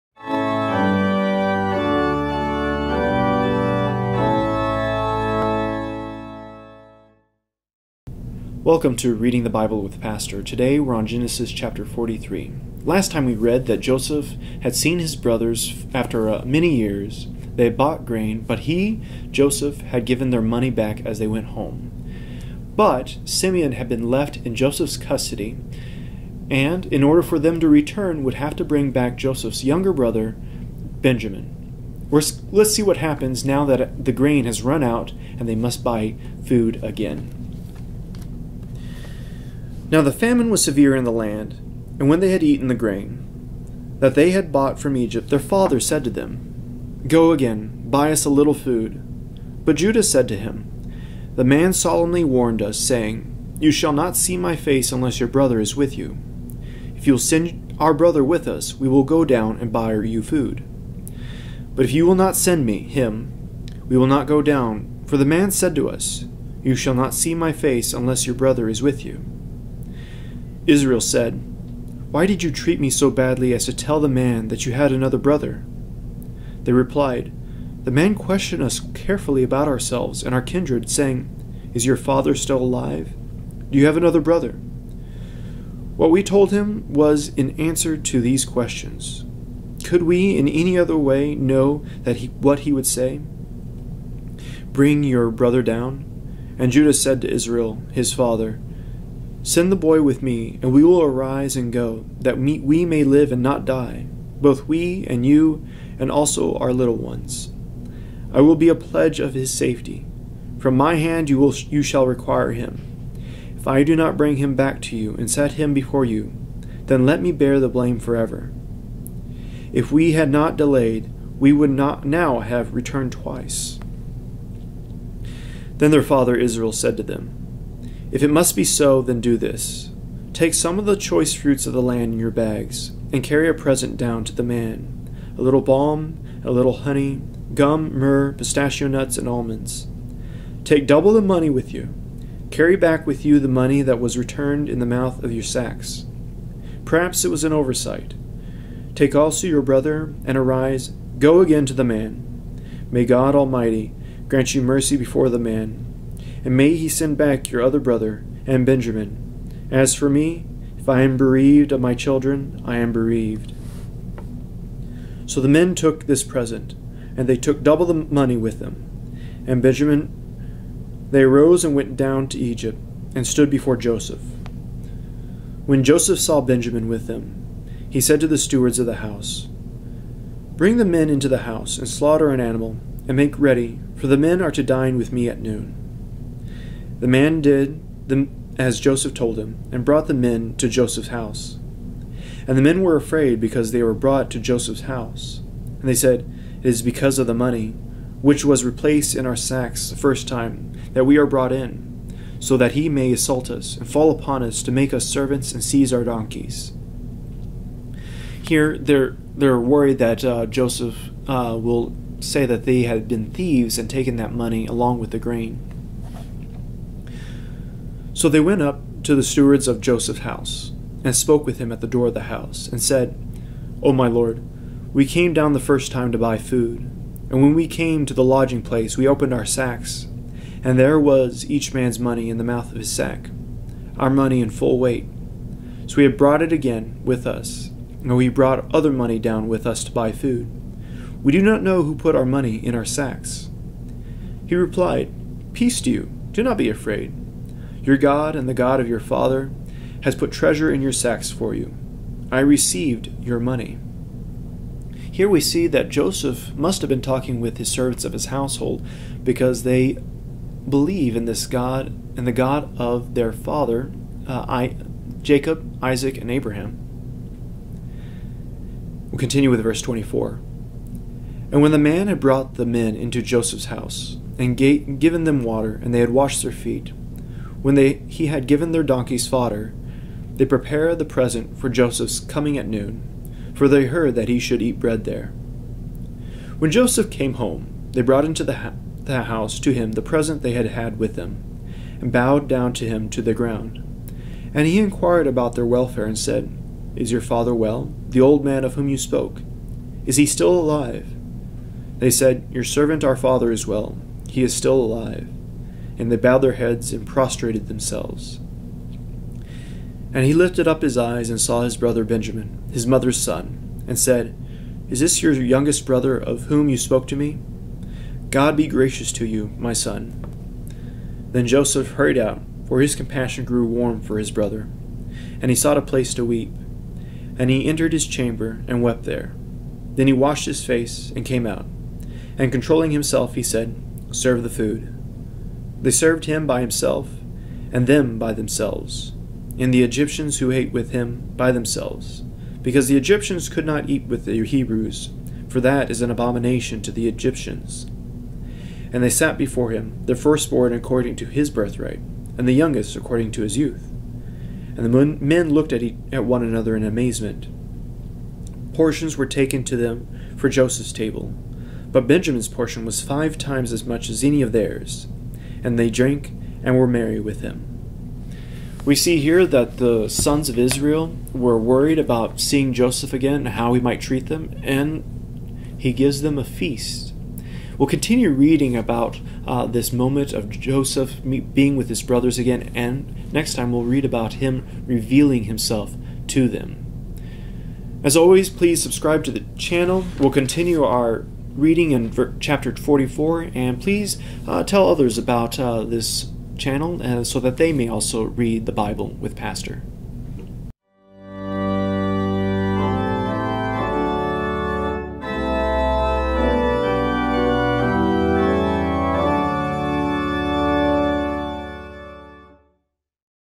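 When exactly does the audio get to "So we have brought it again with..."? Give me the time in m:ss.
3:55.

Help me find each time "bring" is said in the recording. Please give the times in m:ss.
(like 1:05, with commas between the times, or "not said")
0:28, 1:34, 1:54, 3:00.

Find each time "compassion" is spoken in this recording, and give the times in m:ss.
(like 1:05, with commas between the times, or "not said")
5:22.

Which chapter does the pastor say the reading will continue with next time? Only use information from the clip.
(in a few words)
Chapter 44.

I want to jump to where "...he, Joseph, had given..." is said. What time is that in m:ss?
0:18.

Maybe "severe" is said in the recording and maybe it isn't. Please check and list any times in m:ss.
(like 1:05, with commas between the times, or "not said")
0:40.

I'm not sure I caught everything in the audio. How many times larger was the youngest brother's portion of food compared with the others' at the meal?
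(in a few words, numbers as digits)
5.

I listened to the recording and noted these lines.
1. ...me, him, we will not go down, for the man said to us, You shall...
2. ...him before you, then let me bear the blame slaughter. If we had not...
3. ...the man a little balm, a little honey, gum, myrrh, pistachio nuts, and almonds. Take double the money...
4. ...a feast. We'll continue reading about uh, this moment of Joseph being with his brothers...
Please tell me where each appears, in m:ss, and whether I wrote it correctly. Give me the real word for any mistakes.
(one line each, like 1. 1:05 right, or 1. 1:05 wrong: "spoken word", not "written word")
1. 1:02 right
2. 1:55 wrong: "forever", not "slaughter"
3. 2:14 right
4. 6:16 right.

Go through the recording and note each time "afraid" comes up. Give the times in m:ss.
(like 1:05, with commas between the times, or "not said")
3:12, 4:06.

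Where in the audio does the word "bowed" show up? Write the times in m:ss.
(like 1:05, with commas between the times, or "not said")
4:52, 5:06.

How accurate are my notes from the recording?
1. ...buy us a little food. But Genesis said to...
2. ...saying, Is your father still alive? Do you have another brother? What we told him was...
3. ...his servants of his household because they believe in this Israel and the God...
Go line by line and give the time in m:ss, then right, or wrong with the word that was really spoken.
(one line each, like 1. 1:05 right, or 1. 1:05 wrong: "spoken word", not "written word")
1. 0:47 wrong: "Judah", not "Genesis"
2. 1:20 right
3. 4:17 wrong: "God", not "Israel".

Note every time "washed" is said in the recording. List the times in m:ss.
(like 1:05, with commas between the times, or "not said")
4:36, 5:30.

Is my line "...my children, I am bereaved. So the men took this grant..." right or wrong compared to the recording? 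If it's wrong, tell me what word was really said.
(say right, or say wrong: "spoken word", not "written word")
wrong: "present", not "grant".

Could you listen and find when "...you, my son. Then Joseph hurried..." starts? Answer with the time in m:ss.
5:19.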